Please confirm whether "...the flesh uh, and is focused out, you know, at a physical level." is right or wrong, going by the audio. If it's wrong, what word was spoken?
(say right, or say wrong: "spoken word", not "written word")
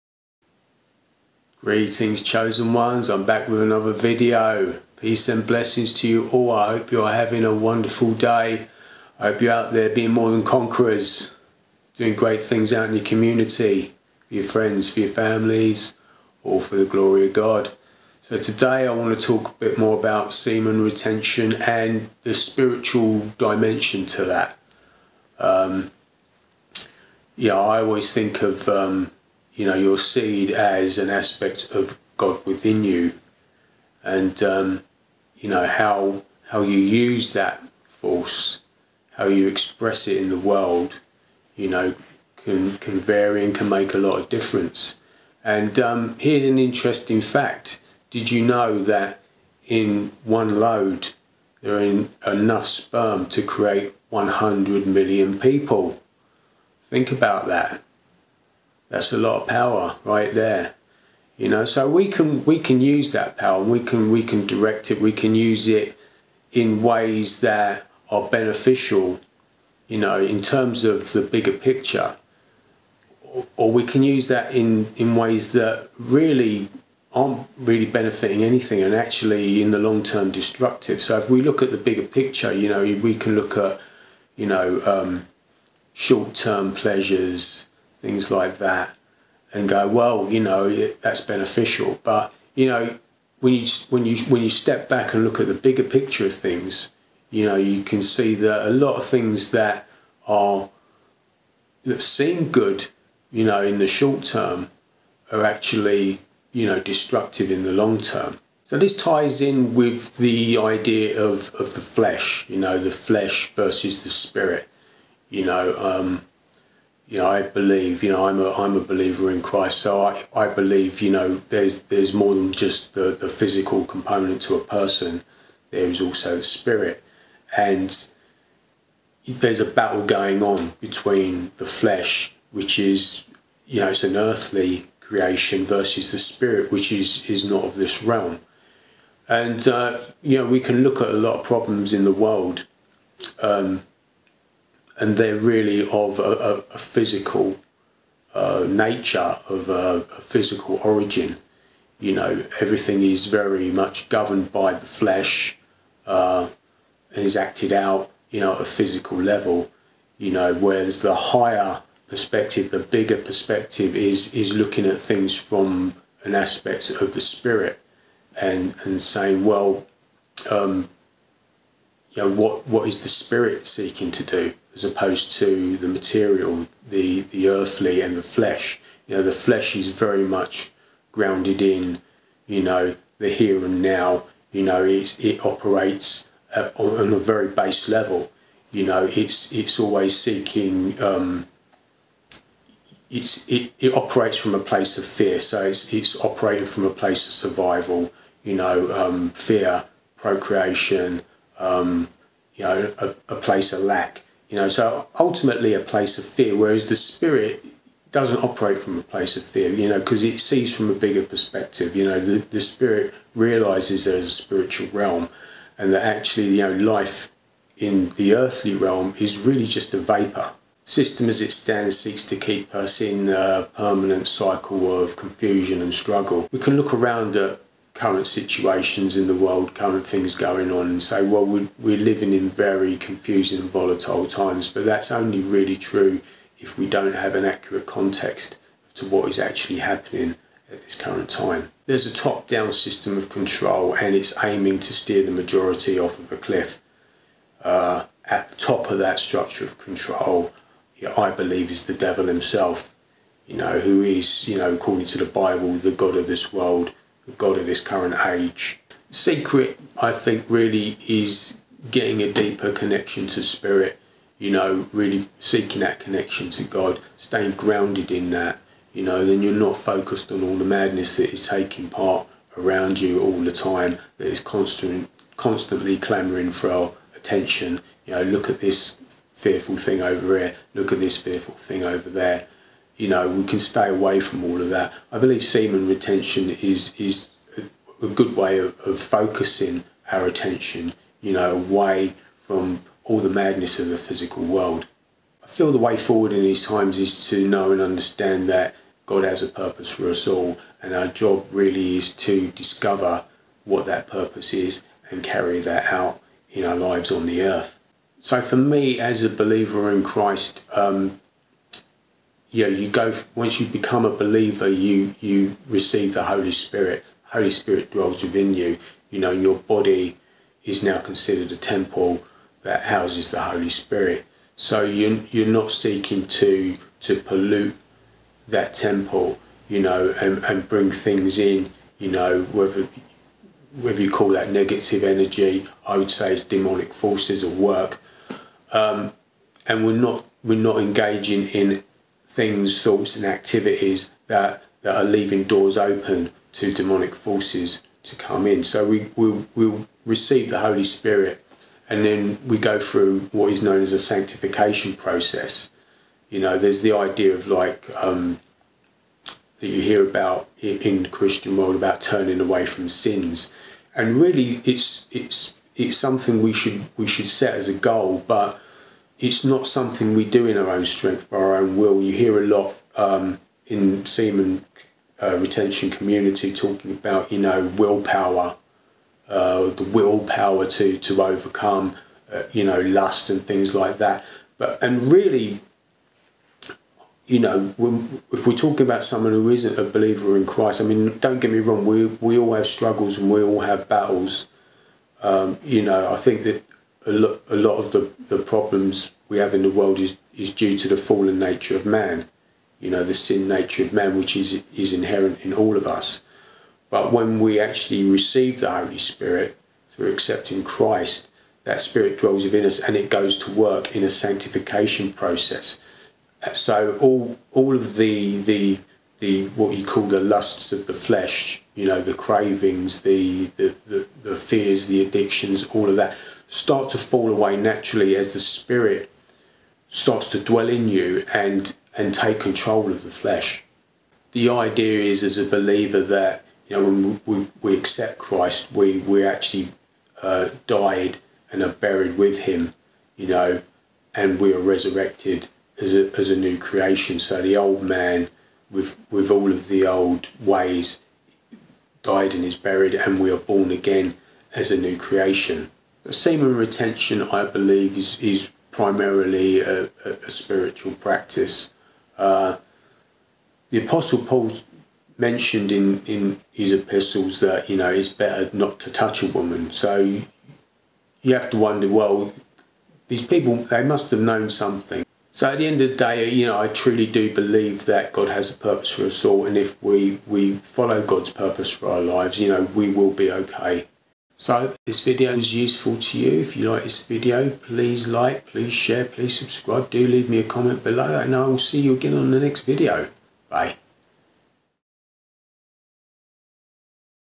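wrong: "acted", not "focused".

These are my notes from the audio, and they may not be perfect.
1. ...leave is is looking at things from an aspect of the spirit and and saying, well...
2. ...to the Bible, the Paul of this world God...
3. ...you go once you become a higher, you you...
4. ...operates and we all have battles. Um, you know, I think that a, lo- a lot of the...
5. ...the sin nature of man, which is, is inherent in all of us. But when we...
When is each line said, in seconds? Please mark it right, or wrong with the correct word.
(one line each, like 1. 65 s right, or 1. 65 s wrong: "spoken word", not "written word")
1. 163 s wrong: "perspective", not "leave"
2. 255 s wrong: "God", not "Paul"
3. 312 s wrong: "believer", not "higher"
4. 392 s wrong: "struggles", not "operates"
5. 403 s right.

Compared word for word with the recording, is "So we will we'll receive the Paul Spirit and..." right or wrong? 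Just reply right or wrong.
wrong.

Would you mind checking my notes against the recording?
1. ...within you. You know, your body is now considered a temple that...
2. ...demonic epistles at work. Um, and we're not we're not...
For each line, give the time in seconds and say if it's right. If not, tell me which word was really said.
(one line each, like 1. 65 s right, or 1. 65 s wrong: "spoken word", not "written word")
1. 318 s right
2. 336 s wrong: "forces", not "epistles".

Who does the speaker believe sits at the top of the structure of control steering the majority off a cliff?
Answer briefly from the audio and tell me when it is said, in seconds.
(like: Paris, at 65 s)
the devil, at 251 s.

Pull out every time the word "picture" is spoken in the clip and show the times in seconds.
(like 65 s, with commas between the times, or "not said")
71 s, 82 s, 95 s.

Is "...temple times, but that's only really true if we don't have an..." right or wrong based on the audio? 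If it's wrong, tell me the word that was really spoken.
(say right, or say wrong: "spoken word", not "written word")
wrong: "volatile", not "temple".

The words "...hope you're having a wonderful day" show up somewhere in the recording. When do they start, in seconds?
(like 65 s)
6 s.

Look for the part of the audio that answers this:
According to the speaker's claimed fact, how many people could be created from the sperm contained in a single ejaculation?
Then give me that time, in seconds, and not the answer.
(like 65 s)
54 s.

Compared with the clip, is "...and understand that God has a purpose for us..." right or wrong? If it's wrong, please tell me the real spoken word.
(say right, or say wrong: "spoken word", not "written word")
right.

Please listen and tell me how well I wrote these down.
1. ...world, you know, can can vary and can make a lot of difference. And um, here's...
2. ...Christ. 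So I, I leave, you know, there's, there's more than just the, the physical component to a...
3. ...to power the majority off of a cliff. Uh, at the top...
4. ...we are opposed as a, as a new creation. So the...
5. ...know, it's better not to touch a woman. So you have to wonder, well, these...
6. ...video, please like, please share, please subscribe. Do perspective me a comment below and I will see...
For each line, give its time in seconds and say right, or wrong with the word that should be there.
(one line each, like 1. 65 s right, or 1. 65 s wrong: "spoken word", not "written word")
1. 40 s right
2. 119 s wrong: "believe", not "leave"
3. 244 s wrong: "steer", not "power"
4. 444 s wrong: "resurrected", not "opposed"
5. 467 s right
6. 487 s wrong: "leave", not "perspective".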